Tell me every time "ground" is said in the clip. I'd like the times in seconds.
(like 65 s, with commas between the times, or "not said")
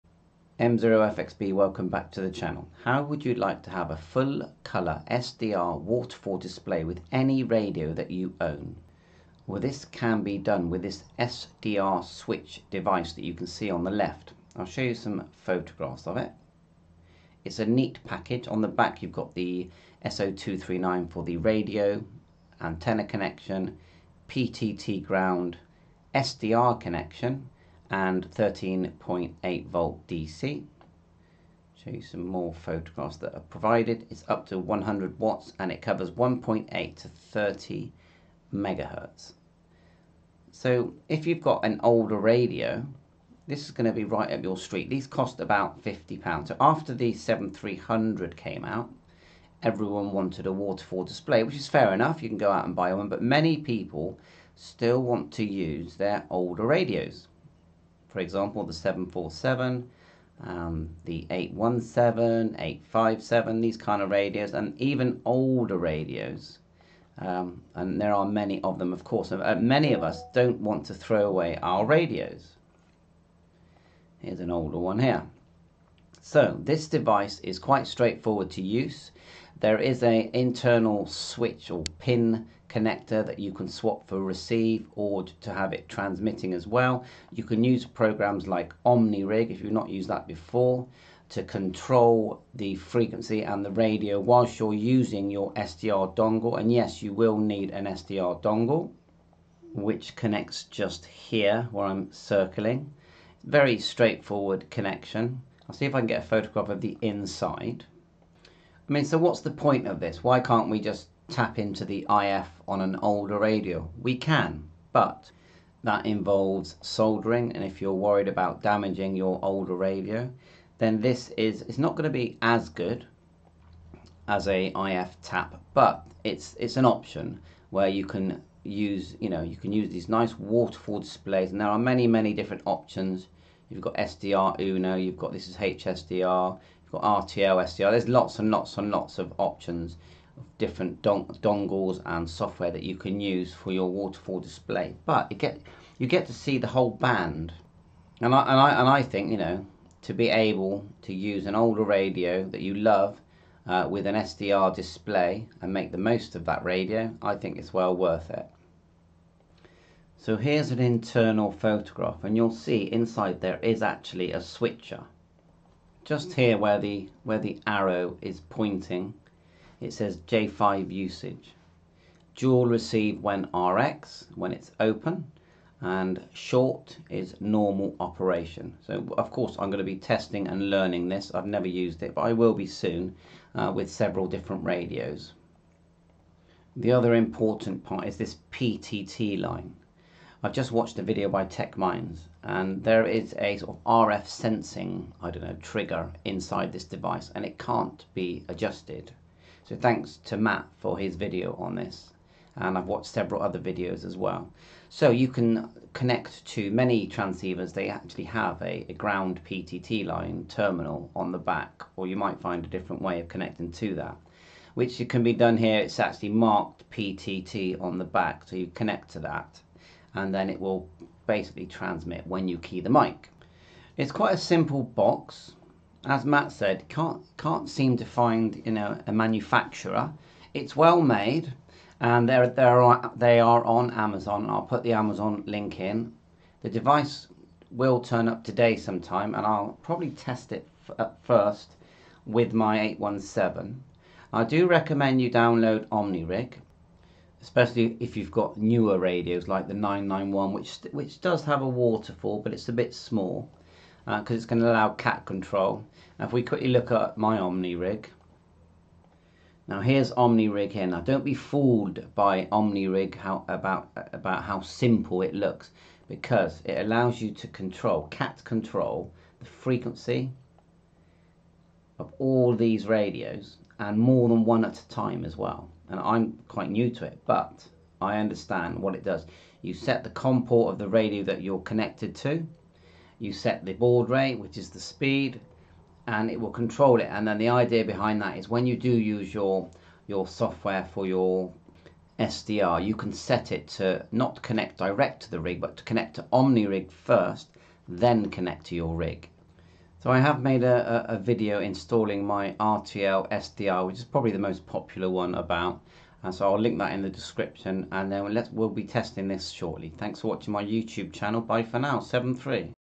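25 s, 208 s.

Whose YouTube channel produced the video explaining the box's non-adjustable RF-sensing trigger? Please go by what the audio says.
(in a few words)
Tech Minds.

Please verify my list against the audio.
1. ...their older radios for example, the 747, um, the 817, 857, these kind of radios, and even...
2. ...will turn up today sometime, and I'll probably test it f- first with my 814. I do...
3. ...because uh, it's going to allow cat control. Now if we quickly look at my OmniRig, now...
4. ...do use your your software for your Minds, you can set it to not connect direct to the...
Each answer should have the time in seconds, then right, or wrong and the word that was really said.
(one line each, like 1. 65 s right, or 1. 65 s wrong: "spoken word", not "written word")
1. 55 s right
2. 237 s wrong: "817", not "814"
3. 254 s right
4. 288 s wrong: "SDR", not "Minds".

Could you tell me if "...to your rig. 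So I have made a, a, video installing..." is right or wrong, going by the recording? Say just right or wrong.
right.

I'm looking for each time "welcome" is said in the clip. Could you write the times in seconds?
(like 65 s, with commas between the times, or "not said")
1 s.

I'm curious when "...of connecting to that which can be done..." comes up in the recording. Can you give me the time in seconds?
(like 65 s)
213 s.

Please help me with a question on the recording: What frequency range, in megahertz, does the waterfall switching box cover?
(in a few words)
1.8 to 30 MHz.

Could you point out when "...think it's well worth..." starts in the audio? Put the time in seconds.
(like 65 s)
157 s.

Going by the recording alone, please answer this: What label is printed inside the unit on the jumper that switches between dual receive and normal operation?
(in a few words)
J5.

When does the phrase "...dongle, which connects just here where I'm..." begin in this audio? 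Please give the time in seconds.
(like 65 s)
98 s.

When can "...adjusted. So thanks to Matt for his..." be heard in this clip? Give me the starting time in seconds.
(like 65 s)
198 s.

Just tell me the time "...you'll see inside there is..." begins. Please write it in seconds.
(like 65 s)
162 s.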